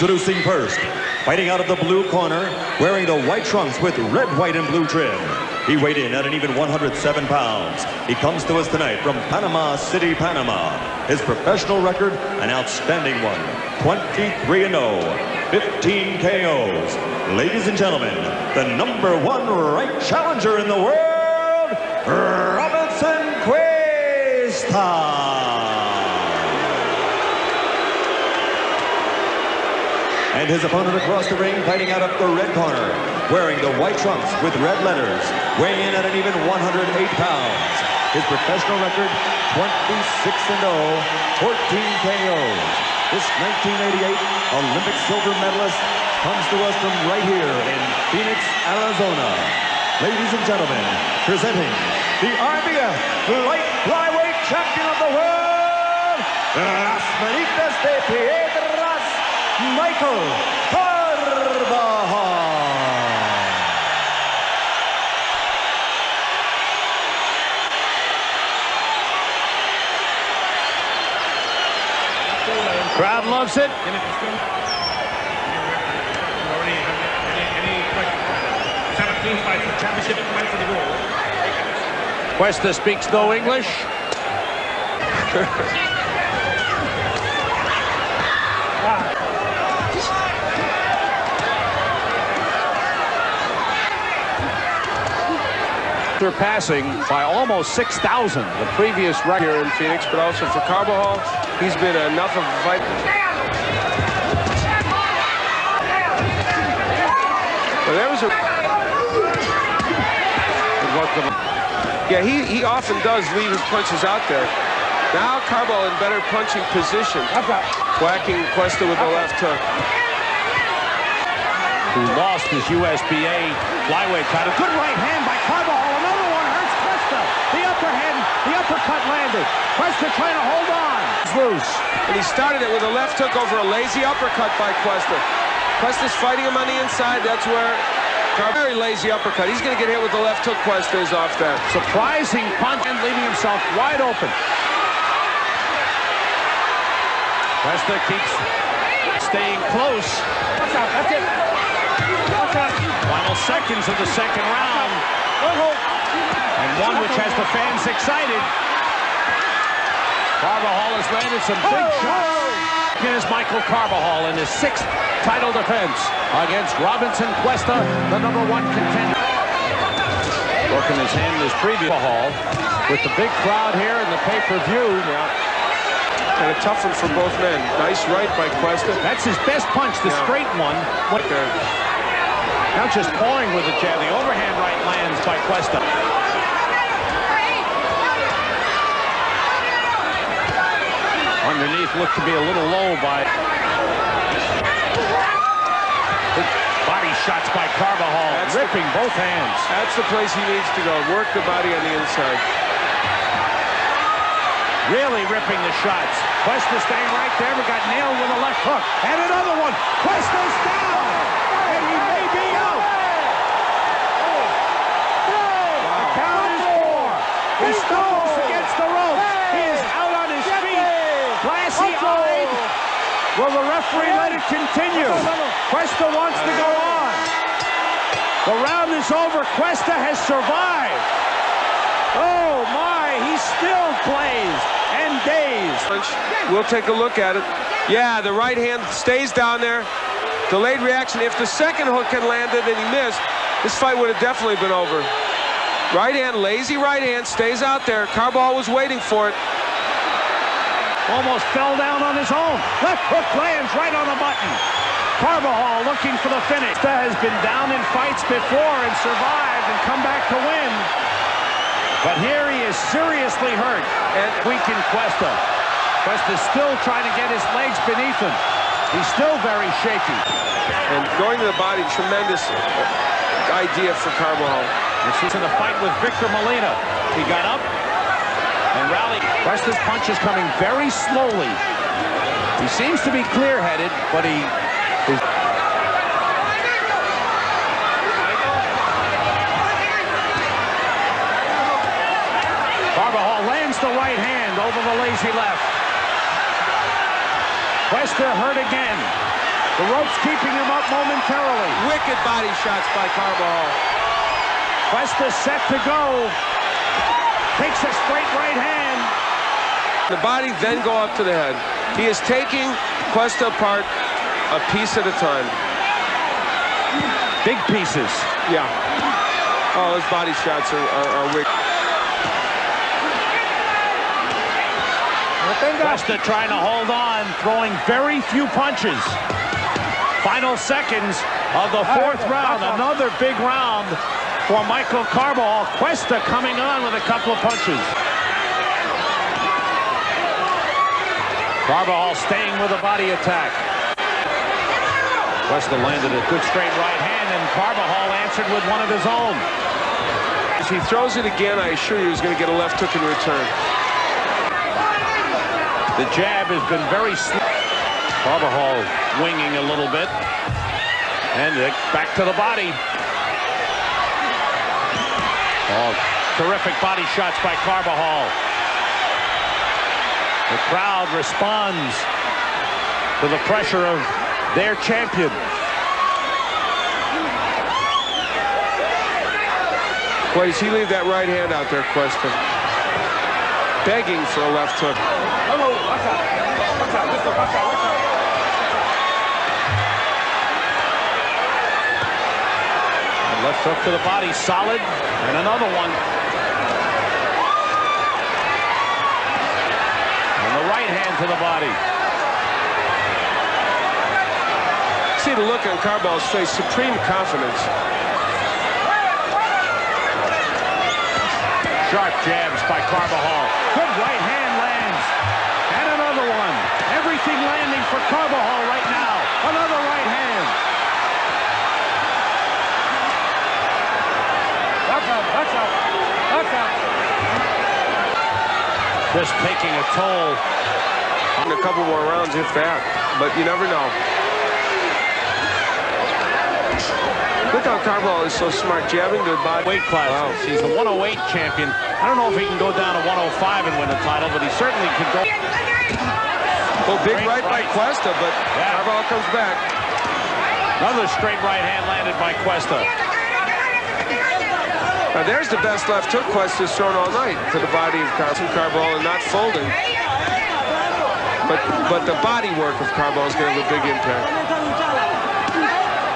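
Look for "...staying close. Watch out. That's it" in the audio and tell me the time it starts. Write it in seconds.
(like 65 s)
149 s.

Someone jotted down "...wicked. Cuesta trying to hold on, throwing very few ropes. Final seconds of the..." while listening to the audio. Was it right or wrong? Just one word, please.
wrong.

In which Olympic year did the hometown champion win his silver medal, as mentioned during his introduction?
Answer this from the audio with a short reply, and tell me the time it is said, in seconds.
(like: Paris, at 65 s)
1988, at 43 s.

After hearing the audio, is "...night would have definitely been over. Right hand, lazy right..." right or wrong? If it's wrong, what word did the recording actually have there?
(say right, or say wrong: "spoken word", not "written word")
wrong: "fight", not "night".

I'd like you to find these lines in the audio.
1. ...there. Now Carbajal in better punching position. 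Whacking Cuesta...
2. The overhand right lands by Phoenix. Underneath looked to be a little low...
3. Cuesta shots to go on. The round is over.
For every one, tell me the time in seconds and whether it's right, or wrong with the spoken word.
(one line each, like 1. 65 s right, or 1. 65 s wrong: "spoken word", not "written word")
1. 114 s right
2. 183 s wrong: "Cuesta", not "Phoenix"
3. 225 s wrong: "wants", not "shots".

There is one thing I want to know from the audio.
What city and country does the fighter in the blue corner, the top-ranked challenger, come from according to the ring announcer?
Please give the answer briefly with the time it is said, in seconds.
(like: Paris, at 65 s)
Panama City, Panama, at 9 s.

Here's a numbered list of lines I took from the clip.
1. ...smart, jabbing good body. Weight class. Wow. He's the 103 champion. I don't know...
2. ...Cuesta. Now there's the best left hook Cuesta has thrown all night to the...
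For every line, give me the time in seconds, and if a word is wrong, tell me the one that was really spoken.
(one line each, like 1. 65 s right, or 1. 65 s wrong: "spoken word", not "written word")
1. 438 s wrong: "108", not "103"
2. 452 s right.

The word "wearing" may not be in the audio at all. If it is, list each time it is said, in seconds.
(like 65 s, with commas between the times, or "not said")
2 s, 33 s.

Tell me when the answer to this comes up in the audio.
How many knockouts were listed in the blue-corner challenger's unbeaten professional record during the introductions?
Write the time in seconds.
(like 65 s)
15 s.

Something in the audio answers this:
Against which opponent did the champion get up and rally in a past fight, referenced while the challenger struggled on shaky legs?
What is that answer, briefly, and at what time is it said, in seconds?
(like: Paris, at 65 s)
Victor Molina, at 275 s.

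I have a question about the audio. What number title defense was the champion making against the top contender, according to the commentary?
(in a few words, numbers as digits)
Sixth.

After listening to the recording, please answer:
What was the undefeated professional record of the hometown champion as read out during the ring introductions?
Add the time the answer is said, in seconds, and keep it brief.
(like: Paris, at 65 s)
26-0, at 39 s.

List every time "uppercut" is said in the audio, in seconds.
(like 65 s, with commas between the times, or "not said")
128 s, 134 s, 139 s.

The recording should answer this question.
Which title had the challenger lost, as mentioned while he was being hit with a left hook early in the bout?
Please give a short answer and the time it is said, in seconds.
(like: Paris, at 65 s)
USBA flyweight title, at 122 s.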